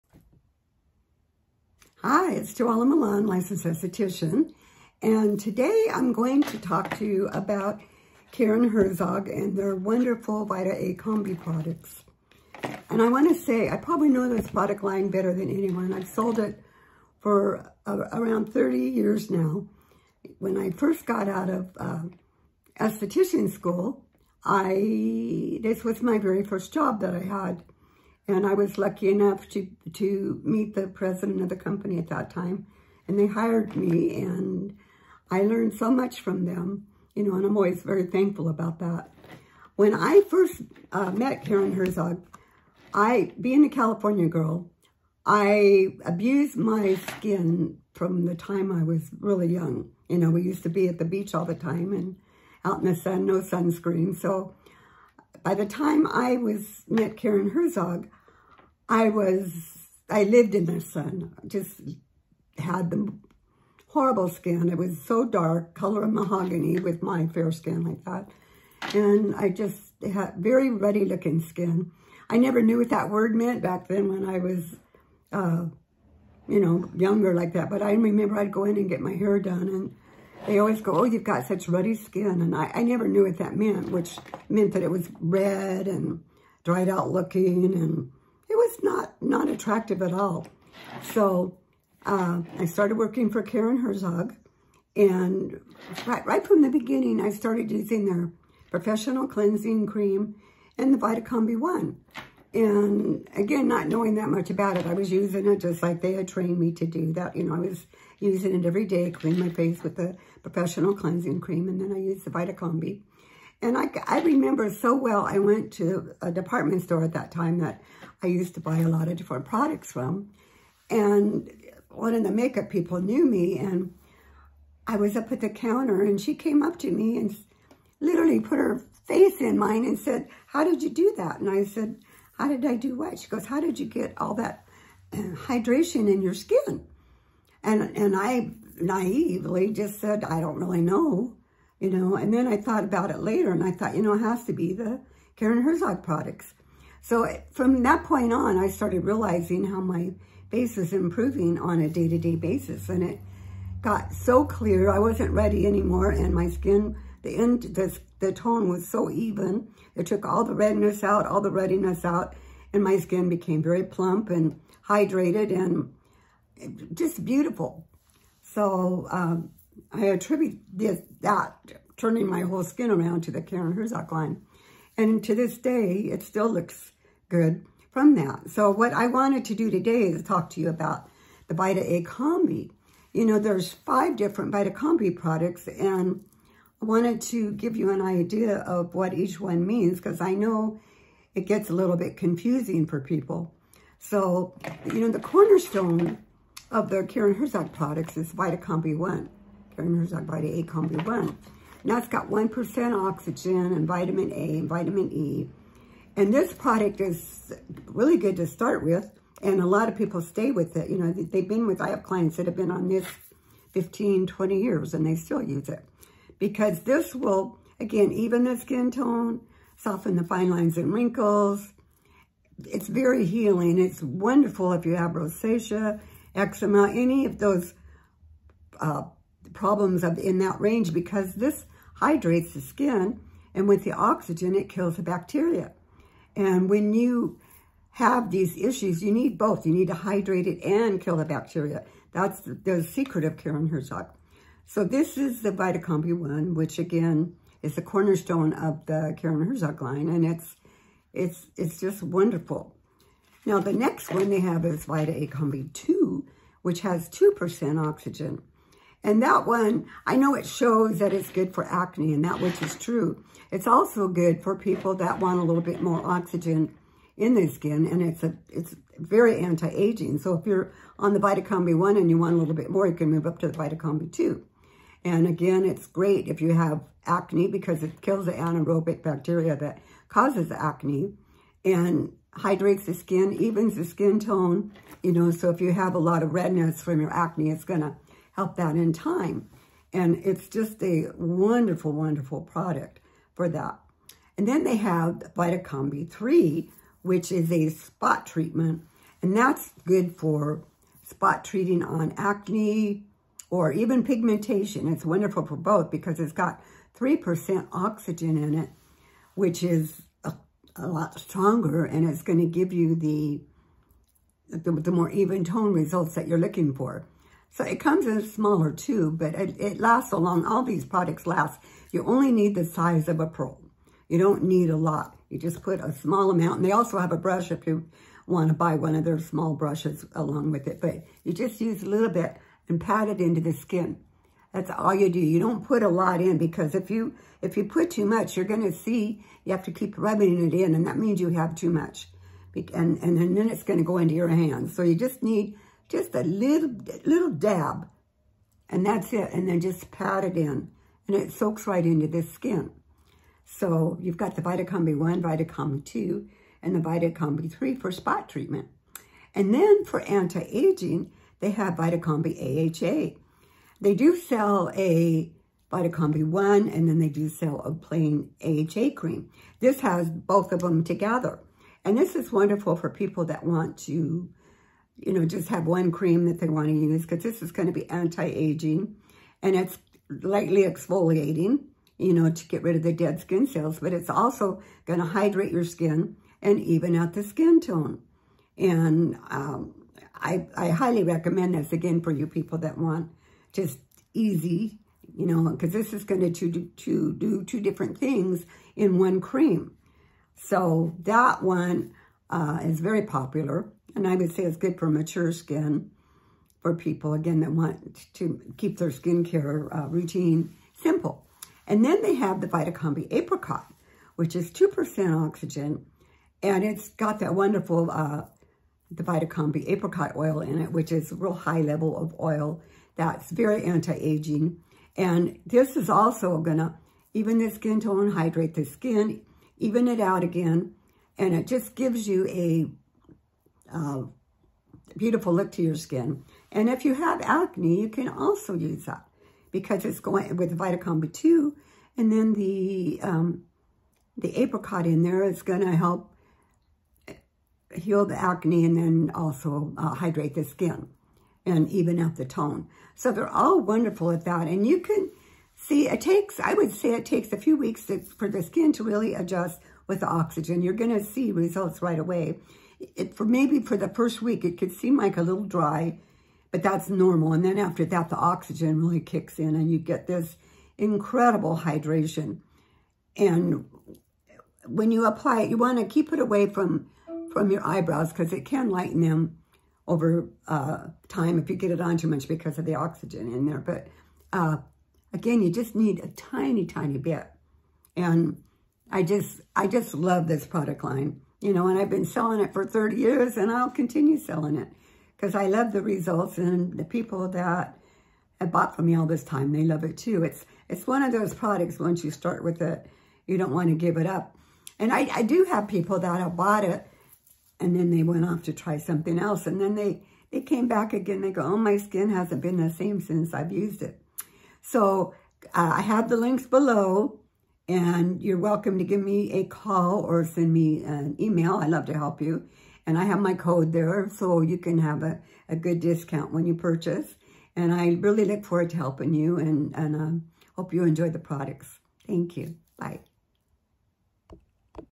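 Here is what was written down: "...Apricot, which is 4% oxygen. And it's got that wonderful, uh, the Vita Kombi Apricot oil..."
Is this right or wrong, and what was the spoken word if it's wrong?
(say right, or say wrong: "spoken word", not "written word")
wrong: "2", not "4".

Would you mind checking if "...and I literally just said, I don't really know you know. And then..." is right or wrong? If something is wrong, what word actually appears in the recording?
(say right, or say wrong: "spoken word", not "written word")
wrong: "naively", not "literally".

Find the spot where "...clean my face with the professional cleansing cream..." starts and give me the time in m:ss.
1:49.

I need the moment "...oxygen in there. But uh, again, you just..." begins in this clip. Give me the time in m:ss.
8:02.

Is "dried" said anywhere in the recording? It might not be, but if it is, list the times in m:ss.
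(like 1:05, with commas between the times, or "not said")
1:26.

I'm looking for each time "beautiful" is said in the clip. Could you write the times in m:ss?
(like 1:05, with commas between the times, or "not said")
2:47, 7:14.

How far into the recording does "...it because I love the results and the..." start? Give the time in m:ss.
8:14.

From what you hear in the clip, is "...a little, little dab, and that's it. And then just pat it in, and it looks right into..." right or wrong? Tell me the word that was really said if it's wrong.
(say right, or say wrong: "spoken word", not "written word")
wrong: "soaks", not "looks".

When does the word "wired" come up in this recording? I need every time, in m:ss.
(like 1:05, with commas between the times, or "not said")
not said.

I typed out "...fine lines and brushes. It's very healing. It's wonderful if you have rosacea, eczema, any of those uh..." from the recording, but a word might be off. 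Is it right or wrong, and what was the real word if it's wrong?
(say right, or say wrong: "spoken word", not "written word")
wrong: "wrinkles", not "brushes".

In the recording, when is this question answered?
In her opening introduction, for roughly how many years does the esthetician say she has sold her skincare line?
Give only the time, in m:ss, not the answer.
0:18.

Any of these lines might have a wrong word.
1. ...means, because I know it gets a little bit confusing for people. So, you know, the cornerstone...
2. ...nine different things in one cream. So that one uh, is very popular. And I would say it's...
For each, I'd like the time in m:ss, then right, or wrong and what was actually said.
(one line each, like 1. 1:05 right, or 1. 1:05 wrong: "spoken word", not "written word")
1. 3:09 right
2. 6:37 wrong: "two", not "nine".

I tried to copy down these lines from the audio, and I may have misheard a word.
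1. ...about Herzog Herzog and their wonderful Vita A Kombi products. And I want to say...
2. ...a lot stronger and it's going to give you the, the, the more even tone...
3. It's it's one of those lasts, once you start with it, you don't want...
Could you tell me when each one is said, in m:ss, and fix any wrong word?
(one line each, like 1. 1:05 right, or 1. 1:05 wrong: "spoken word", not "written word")
1. 0:07 wrong: "Karin", not "Herzog"
2. 5:10 right
3. 8:20 wrong: "products", not "lasts".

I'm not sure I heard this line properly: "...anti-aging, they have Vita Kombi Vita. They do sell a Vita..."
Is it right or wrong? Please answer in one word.
wrong.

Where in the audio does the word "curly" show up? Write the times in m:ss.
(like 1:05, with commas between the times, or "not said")
not said.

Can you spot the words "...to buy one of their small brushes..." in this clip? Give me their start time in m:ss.
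5:28.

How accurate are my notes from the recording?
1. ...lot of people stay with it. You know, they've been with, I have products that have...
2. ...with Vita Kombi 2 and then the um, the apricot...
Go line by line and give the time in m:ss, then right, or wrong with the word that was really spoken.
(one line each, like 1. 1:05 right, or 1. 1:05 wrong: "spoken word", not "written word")
1. 3:29 wrong: "clients", not "products"
2. 7:20 right.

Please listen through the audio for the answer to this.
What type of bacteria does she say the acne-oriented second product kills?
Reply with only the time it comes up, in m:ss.
4:38.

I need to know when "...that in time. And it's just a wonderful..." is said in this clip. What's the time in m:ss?
4:48.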